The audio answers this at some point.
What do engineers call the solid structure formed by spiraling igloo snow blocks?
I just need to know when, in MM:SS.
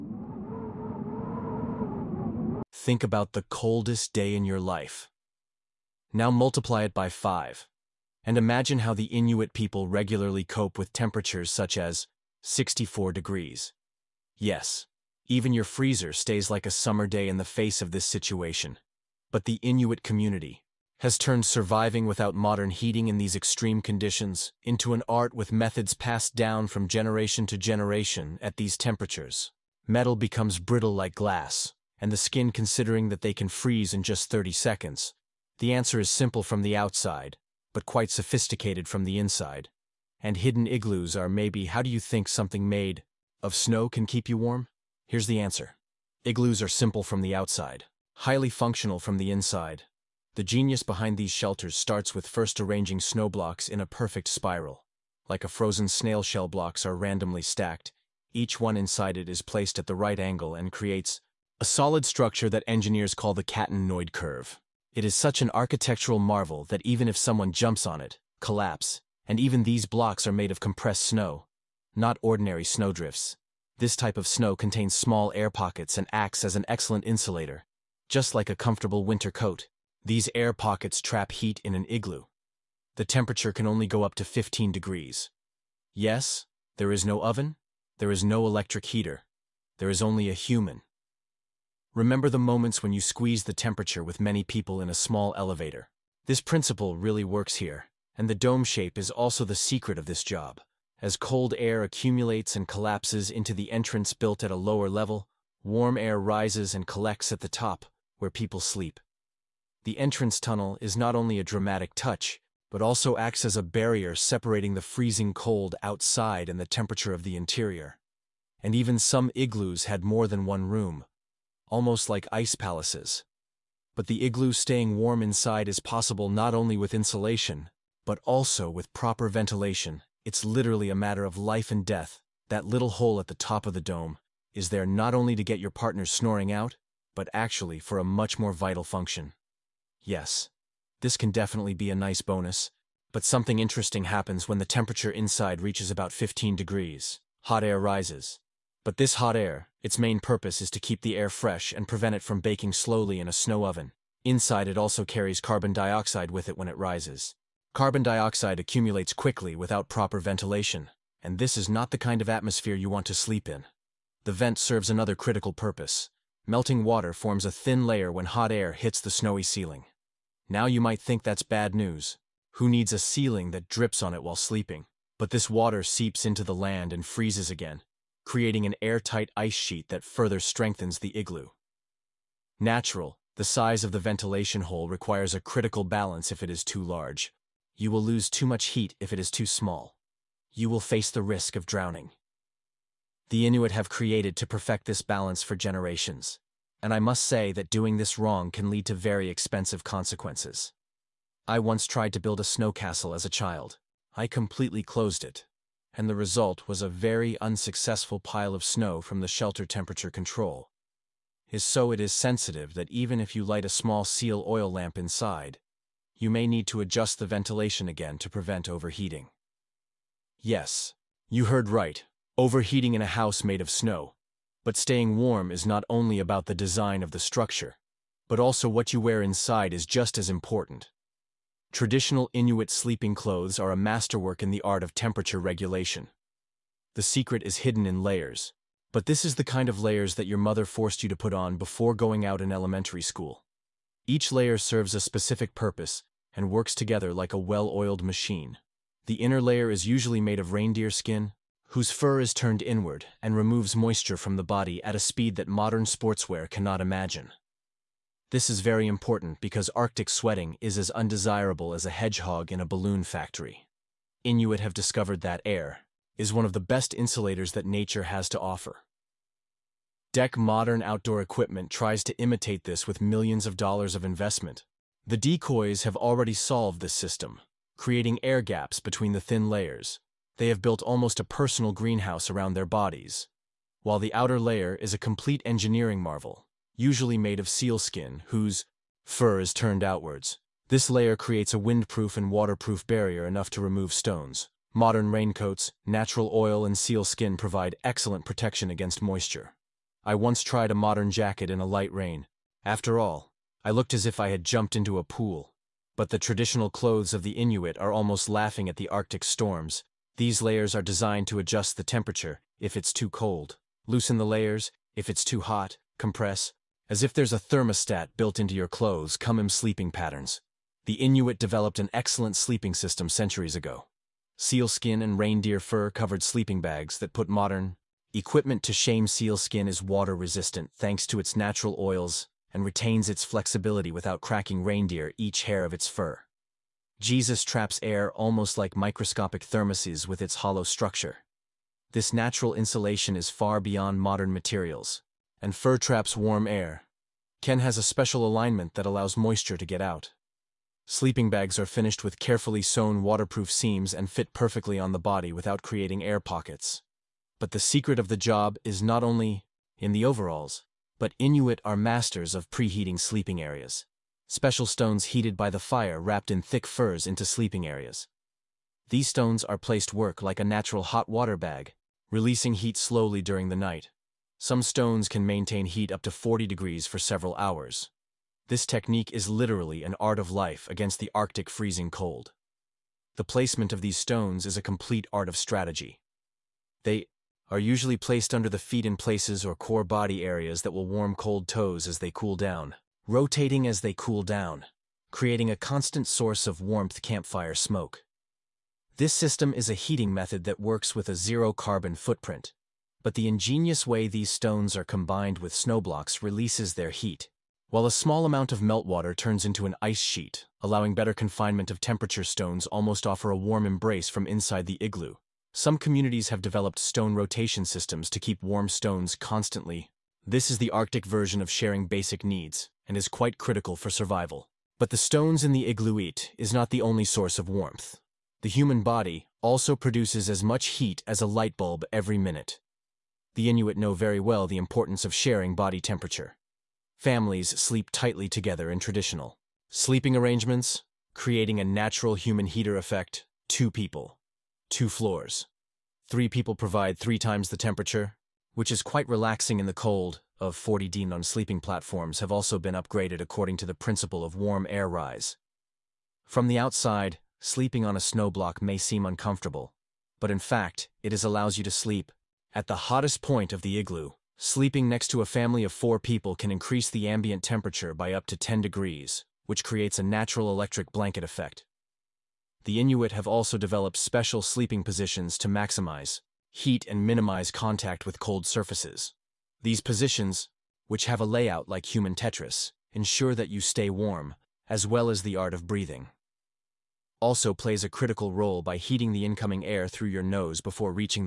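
01:03.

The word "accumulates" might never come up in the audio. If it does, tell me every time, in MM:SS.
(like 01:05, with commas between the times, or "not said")
01:41, 02:38.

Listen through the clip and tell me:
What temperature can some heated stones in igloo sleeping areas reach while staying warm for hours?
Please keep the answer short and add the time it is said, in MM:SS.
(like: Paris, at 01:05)
40 degrees, at 06:16.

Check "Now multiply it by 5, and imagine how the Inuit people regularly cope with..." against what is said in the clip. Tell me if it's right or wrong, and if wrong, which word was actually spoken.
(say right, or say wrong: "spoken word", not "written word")
right.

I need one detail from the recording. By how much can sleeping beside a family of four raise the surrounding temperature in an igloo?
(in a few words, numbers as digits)
10 degrees.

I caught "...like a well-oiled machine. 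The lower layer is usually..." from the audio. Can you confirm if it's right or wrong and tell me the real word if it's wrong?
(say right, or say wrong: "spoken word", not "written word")
wrong: "inner", not "lower".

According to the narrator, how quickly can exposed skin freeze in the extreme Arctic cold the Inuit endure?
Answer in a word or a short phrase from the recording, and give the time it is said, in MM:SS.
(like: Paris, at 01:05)
30 seconds, at 00:34.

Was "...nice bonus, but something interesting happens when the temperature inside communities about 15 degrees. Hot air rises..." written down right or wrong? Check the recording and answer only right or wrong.
wrong.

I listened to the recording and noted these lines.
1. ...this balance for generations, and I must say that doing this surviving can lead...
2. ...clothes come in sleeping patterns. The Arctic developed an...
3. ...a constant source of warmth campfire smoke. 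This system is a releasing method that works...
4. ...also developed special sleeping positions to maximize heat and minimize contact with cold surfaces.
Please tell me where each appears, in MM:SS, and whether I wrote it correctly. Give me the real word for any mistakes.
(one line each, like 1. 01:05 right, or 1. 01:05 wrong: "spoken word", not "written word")
1. 03:14 wrong: "wrong", not "surviving"
2. 05:18 wrong: "Inuit", not "Arctic"
3. 06:35 wrong: "heating", not "releasing"
4. 07:53 right.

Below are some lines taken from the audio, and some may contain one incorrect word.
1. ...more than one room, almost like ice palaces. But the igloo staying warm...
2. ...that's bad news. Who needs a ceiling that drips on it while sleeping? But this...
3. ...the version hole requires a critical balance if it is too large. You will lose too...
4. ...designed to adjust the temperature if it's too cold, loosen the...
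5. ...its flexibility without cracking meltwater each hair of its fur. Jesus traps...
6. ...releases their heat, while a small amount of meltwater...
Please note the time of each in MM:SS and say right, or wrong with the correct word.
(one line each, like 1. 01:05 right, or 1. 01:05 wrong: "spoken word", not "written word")
1. 02:00 right
2. 02:51 right
3. 03:03 wrong: "ventilation", not "version"
4. 05:10 right
5. 05:33 wrong: "reindeer", not "meltwater"
6. 06:46 right.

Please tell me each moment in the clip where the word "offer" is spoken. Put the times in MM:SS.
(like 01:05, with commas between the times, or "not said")
04:28, 06:53.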